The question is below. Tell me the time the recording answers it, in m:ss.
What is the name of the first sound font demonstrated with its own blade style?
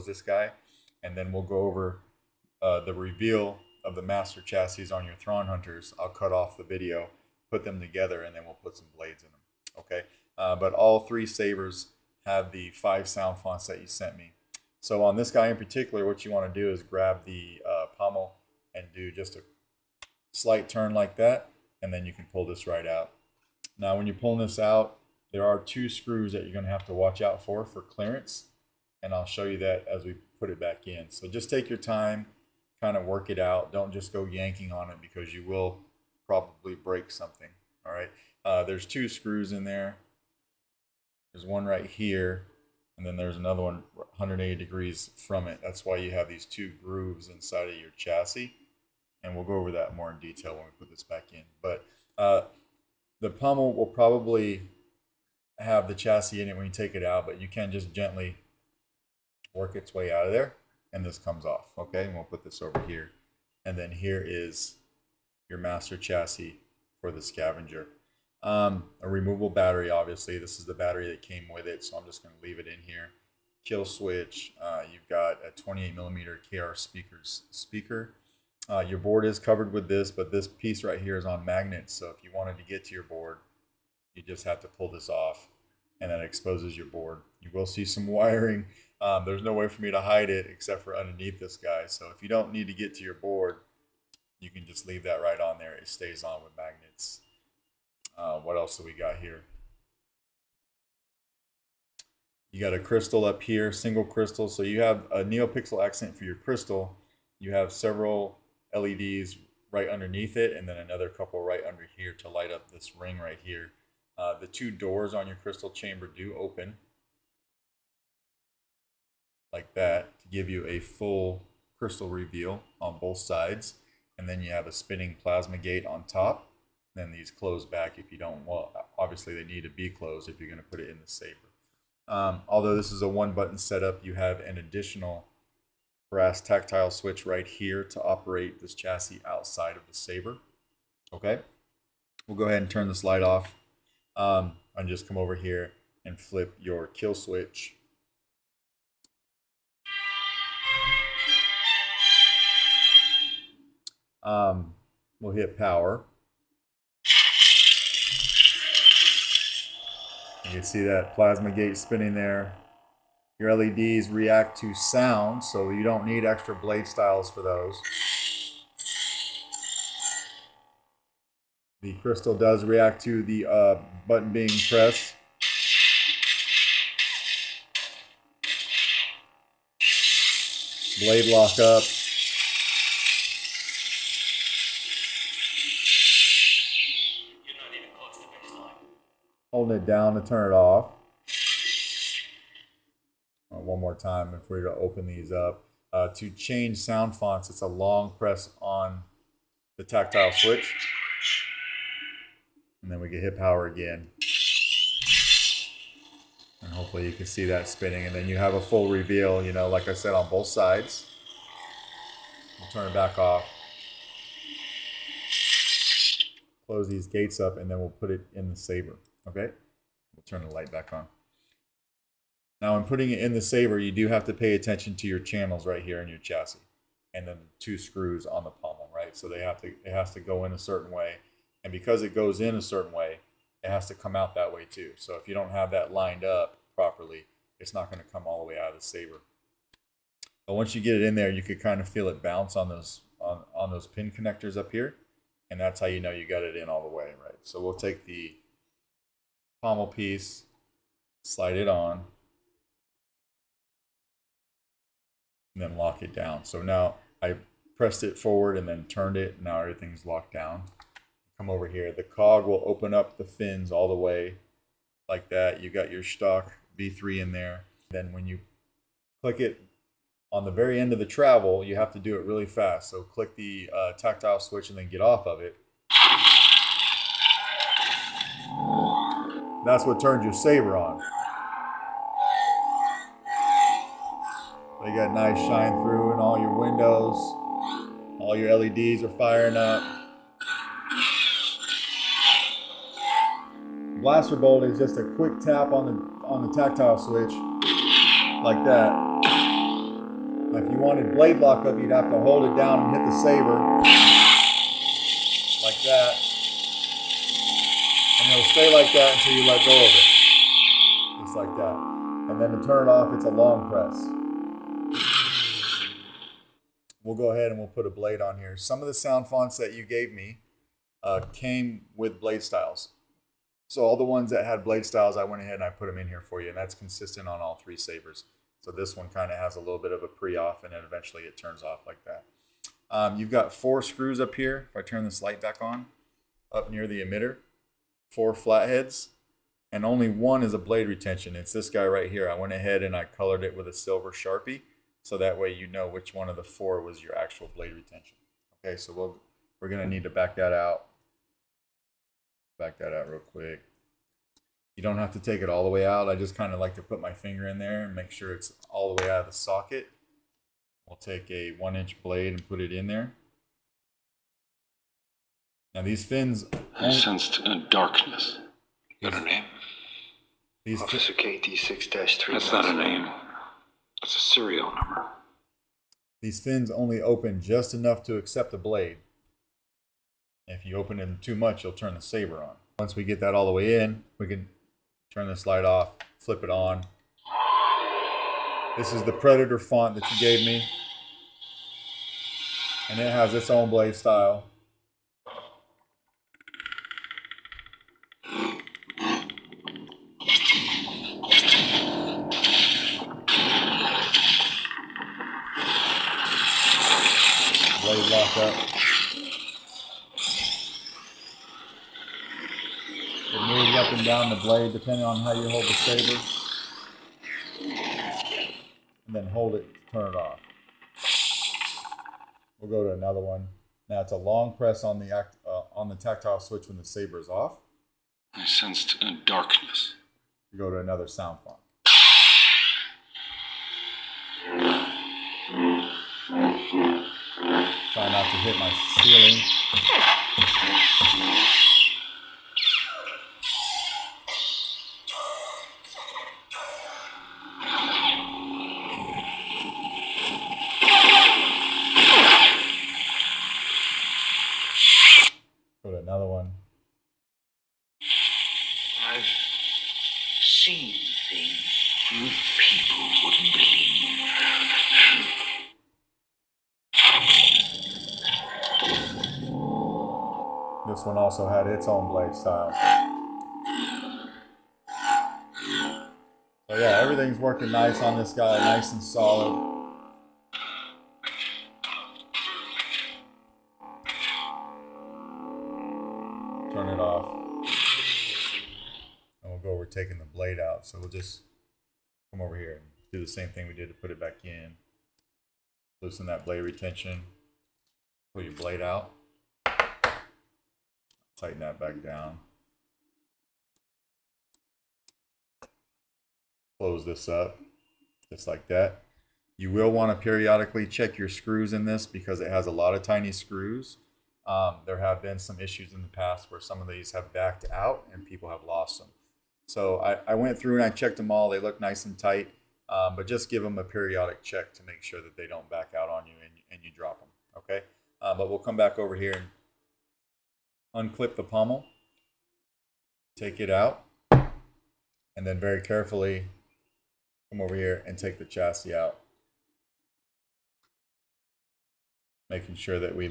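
6:29.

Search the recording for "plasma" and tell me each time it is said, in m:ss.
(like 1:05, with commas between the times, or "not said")
2:05, 2:41.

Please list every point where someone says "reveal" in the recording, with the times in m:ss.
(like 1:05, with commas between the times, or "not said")
0:02, 2:02, 3:28.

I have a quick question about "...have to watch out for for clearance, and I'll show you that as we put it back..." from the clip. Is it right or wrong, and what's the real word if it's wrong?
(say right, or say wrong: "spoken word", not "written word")
right.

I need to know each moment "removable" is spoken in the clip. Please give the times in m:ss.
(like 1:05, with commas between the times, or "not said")
1:09.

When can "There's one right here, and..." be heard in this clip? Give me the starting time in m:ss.
0:41.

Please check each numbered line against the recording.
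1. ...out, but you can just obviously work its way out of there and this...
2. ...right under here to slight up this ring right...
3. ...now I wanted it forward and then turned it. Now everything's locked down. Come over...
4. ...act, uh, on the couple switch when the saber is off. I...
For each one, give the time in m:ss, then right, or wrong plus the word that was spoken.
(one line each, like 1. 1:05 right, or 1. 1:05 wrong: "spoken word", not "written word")
1. 0:57 wrong: "gently", not "obviously"
2. 1:51 wrong: "light", not "slight"
3. 4:16 wrong: "pressed", not "wanted"
4. 7:05 wrong: "tactile", not "couple".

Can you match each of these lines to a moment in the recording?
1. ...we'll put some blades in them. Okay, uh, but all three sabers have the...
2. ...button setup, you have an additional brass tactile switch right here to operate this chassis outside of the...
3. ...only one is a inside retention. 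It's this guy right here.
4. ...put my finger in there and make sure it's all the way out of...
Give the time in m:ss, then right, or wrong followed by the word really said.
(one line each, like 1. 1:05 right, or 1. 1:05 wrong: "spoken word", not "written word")
1. 0:08 right
2. 2:13 right
3. 5:39 wrong: "blade", not "inside"
4. 5:56 right.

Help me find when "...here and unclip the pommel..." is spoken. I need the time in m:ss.
8:49.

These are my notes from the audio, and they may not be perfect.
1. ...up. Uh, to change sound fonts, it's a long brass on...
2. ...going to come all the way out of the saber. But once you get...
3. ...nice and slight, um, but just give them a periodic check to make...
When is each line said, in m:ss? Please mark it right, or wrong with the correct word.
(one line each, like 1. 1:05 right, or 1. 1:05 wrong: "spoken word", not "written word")
1. 3:15 wrong: "press", not "brass"
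2. 3:57 right
3. 8:41 wrong: "tight", not "slight".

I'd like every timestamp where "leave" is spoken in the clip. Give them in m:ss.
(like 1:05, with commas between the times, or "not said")
1:12, 1:34.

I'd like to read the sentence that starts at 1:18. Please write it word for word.
Uh, your board is covered with this, but this piece right here is on magnets.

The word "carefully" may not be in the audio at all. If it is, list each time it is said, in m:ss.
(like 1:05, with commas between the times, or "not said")
8:55.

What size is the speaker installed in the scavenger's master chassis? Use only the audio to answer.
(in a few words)
28 millimeter.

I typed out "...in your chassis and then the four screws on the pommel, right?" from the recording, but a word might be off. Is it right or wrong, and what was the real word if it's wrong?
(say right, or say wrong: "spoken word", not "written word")
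wrong: "two", not "four".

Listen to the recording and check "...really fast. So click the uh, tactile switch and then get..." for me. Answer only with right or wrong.
right.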